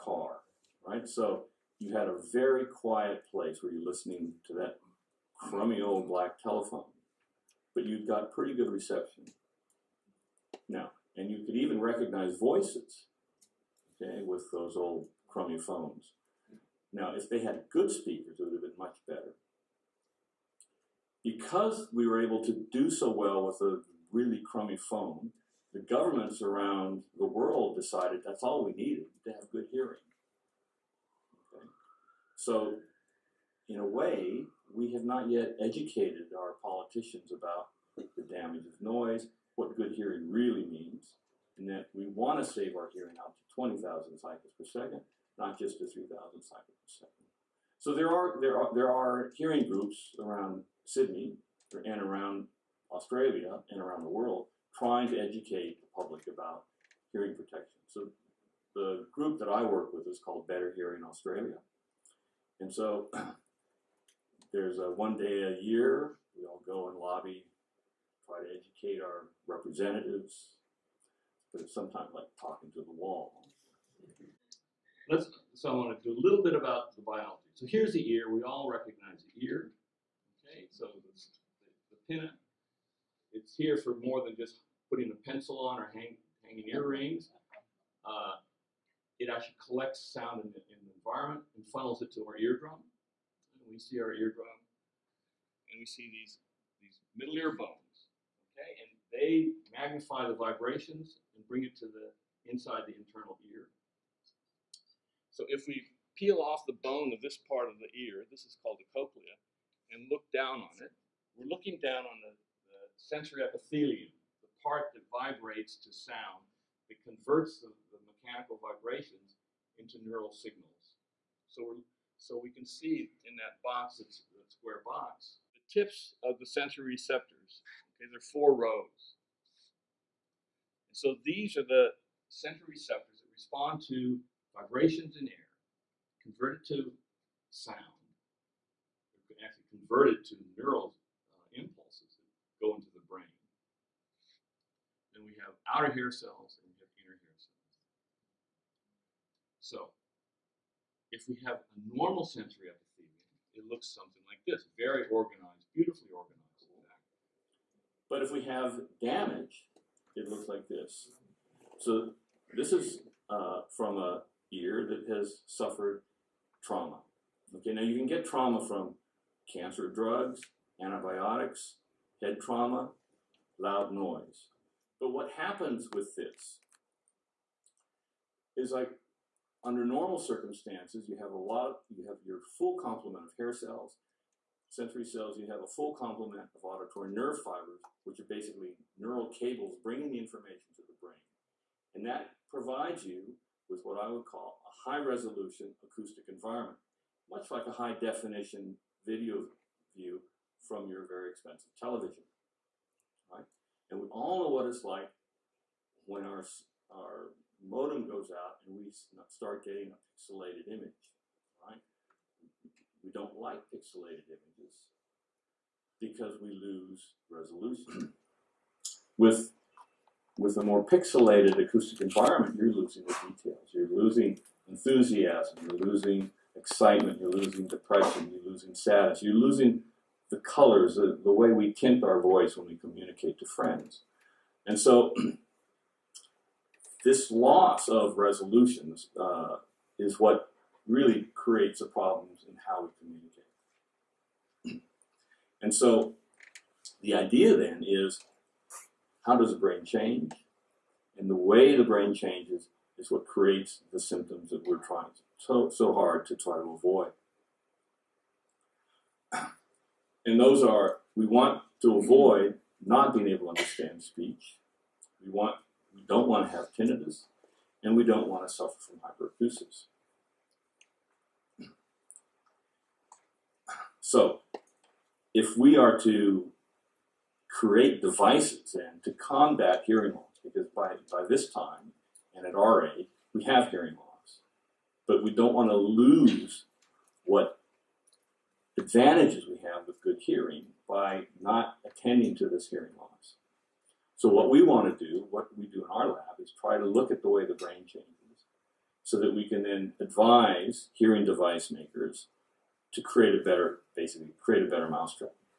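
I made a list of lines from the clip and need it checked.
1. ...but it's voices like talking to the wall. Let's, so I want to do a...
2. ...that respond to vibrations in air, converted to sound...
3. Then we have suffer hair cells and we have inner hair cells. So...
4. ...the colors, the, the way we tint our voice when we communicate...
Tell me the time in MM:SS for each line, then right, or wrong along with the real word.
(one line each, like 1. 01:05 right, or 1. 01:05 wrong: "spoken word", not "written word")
1. 01:11 wrong: "sometimes", not "voices"
2. 02:13 right
3. 02:25 wrong: "outer", not "suffer"
4. 03:50 right.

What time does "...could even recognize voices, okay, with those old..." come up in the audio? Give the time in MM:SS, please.
00:11.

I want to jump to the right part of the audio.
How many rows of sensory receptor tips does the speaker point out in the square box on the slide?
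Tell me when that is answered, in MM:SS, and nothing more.
02:08.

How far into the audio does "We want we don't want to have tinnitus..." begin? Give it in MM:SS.
04:25.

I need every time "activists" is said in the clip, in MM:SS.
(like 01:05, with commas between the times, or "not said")
not said.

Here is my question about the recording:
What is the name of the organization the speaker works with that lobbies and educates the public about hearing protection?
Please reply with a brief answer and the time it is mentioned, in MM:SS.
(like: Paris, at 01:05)
Better Hearing Australia, at 01:00.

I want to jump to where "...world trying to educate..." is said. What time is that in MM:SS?
00:54.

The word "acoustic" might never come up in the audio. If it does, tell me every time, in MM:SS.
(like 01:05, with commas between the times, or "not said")
03:15, 03:41.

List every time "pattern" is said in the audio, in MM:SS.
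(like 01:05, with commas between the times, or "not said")
not said.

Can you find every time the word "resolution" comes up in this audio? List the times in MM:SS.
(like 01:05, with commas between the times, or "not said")
03:15, 03:37, 03:58.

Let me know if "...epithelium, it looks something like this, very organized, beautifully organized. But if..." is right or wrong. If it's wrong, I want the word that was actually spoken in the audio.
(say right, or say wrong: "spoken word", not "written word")
right.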